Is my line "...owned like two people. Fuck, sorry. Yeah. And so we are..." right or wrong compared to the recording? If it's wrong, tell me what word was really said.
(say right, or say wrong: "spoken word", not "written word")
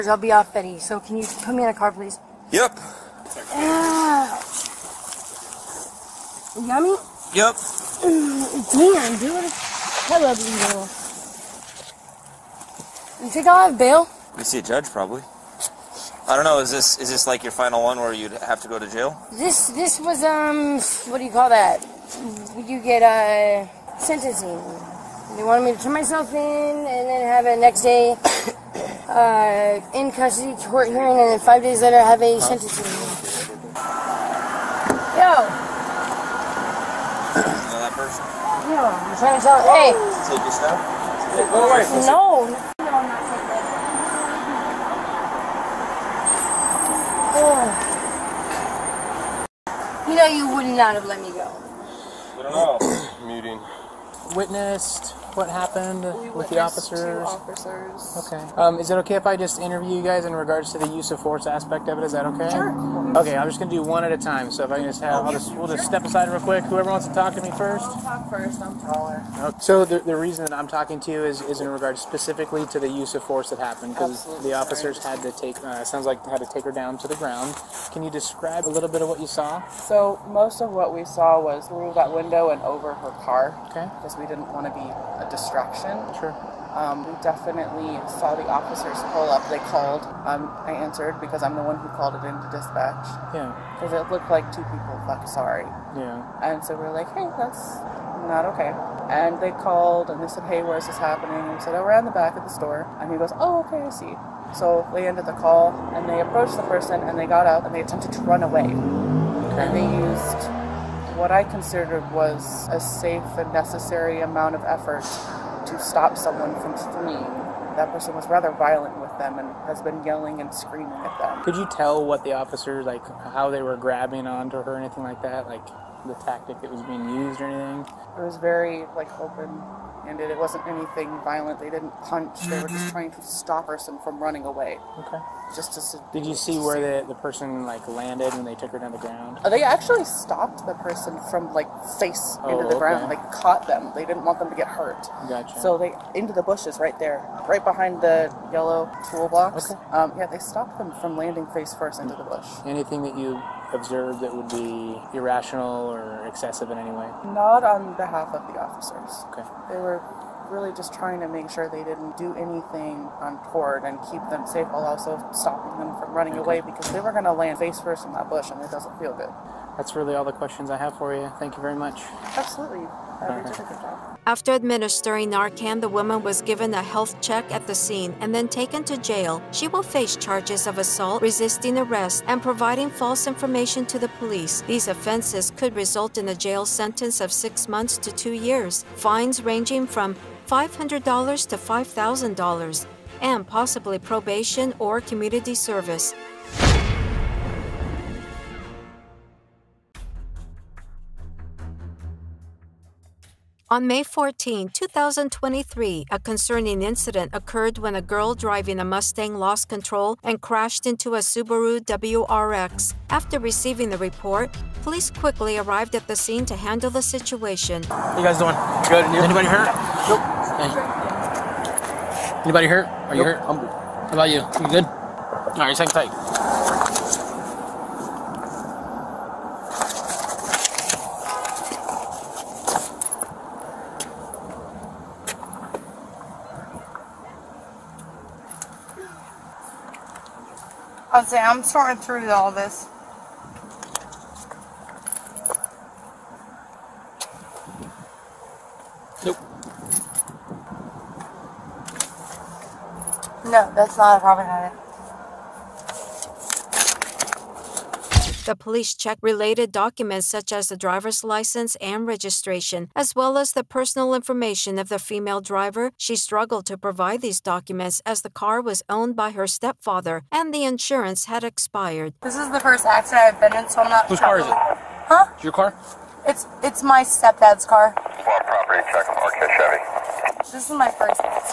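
wrong: "looked", not "owned".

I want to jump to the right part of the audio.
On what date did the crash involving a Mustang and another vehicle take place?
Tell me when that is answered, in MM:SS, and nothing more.
03:23.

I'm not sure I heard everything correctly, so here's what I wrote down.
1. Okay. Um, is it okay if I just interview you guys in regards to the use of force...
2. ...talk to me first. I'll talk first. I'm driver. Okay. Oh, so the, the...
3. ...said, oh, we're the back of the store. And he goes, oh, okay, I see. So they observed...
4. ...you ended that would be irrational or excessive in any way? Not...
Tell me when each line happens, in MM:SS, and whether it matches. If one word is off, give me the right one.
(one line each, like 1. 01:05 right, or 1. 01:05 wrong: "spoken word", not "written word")
1. 00:58 right
2. 01:07 wrong: "taller", not "driver"
3. 01:41 wrong: "ended", not "observed"
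4. 02:33 wrong: "observed", not "ended".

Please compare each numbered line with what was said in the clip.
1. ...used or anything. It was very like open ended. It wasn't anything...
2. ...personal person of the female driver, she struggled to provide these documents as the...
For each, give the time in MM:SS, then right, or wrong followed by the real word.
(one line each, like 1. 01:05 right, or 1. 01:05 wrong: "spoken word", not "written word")
1. 02:07 right
2. 04:23 wrong: "information", not "person".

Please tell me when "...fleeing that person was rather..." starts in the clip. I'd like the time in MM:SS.
01:56.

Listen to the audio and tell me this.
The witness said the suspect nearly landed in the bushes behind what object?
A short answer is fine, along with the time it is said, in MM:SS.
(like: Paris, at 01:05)
yellow toolbox, at 02:28.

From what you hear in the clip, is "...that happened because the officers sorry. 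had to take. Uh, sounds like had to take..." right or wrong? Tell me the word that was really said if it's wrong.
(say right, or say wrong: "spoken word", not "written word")
right.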